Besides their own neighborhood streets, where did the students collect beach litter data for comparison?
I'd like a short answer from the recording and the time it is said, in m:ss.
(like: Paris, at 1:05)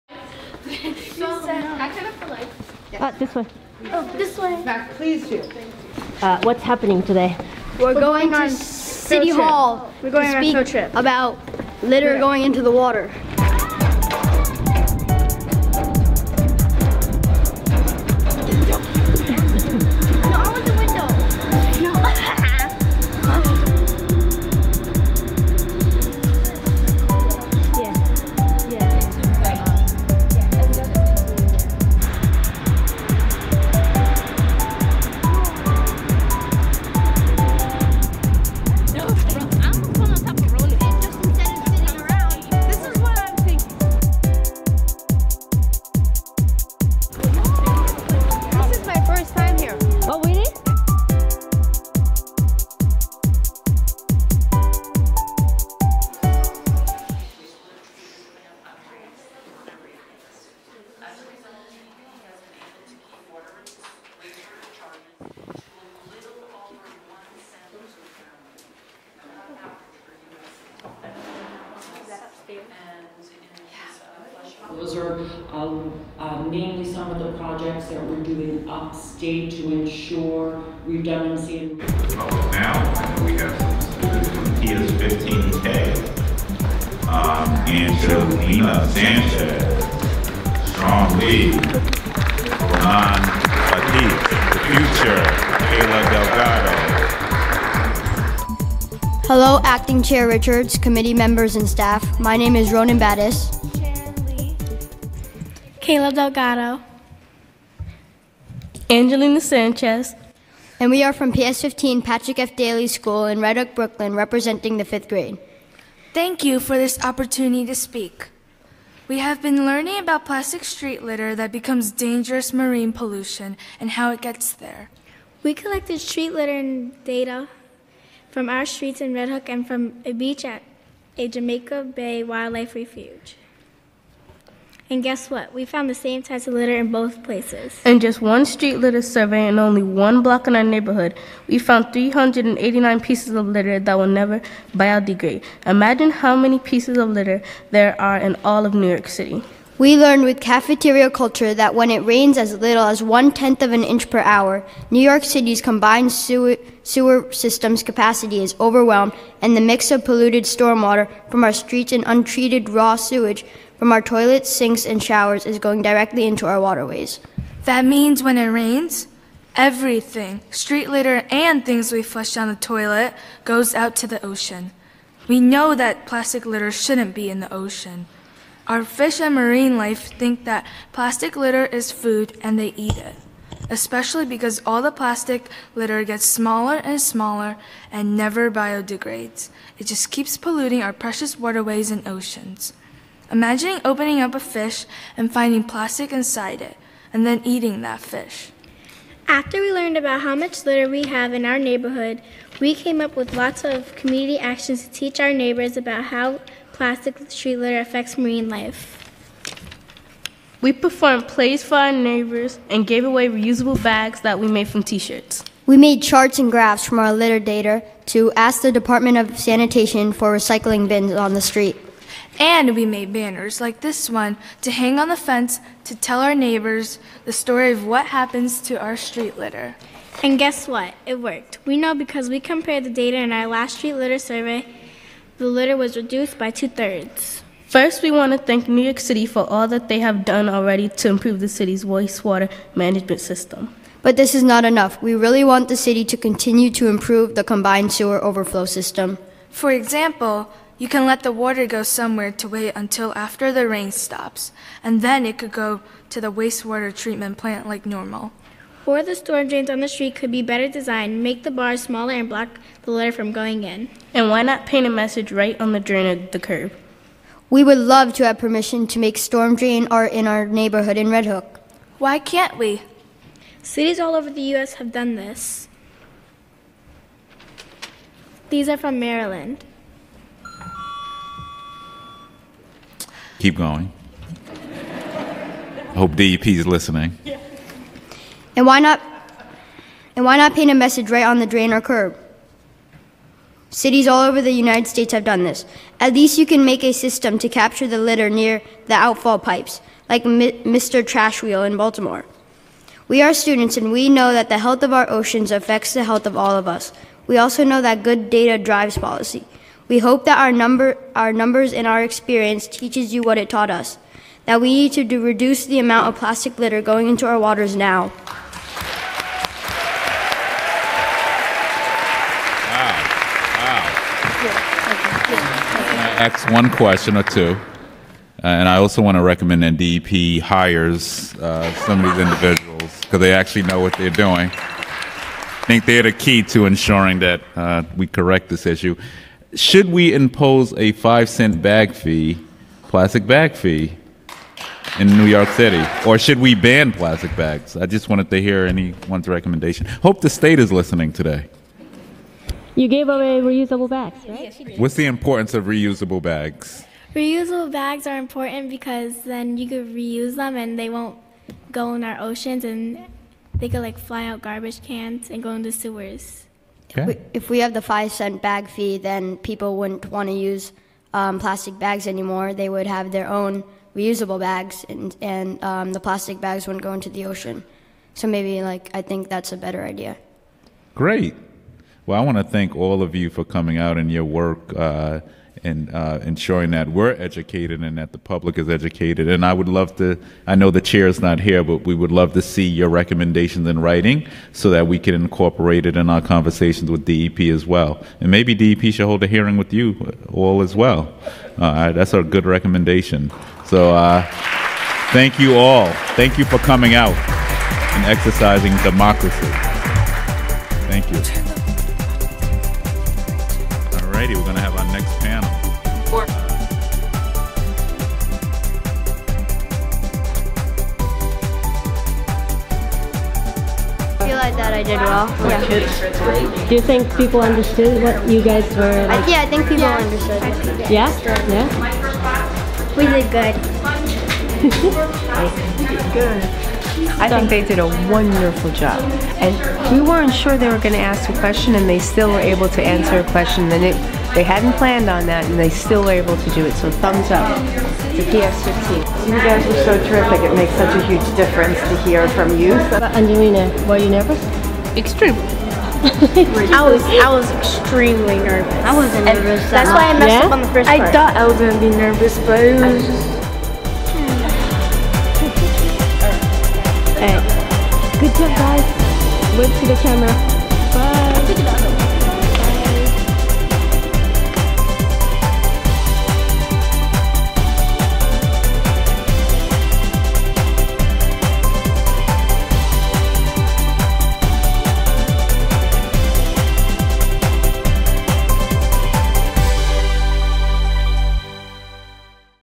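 Jamaica Bay Wildlife Refuge, at 2:11.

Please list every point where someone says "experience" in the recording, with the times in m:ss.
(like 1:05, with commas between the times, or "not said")
5:12.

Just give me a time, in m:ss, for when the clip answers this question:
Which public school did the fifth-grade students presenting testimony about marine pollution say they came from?
1:51.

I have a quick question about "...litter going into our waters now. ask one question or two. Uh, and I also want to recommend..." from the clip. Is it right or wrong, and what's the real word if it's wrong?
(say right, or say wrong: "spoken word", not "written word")
right.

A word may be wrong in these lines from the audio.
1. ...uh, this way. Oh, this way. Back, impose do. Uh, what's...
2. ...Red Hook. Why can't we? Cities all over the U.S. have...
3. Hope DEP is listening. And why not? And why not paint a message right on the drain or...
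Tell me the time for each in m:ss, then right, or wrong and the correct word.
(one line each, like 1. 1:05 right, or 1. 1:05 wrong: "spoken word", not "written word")
1. 0:02 wrong: "please", not "impose"
2. 4:31 right
3. 4:45 right.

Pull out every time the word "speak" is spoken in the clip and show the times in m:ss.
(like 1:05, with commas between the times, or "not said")
0:10, 1:57.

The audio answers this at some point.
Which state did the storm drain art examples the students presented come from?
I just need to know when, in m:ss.
4:38.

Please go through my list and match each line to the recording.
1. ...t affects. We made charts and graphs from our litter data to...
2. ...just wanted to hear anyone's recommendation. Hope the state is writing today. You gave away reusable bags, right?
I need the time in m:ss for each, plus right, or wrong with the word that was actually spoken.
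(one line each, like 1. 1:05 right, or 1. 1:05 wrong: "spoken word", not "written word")
1. 3:34 wrong: "shirts", not "affects"
2. 5:47 wrong: "listening", not "writing".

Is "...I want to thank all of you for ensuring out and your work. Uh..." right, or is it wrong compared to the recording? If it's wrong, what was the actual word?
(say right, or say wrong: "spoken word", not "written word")
wrong: "coming", not "ensuring".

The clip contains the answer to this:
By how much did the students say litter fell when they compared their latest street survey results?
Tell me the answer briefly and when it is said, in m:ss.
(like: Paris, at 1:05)
two thirds, at 3:56.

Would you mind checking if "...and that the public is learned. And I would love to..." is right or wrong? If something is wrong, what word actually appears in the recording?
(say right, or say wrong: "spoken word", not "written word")
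wrong: "educated", not "learned".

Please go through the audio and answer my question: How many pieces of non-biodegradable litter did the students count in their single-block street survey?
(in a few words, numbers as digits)
389.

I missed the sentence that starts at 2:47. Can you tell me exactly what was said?
That means when it rains, everything, street litter and things we flush down the toilet, goes out to the ocean.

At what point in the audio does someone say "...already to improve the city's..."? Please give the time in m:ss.
4:00.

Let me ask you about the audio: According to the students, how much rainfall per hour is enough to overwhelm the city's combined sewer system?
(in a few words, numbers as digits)
one tenth of an inch.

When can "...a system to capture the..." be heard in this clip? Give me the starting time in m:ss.
4:56.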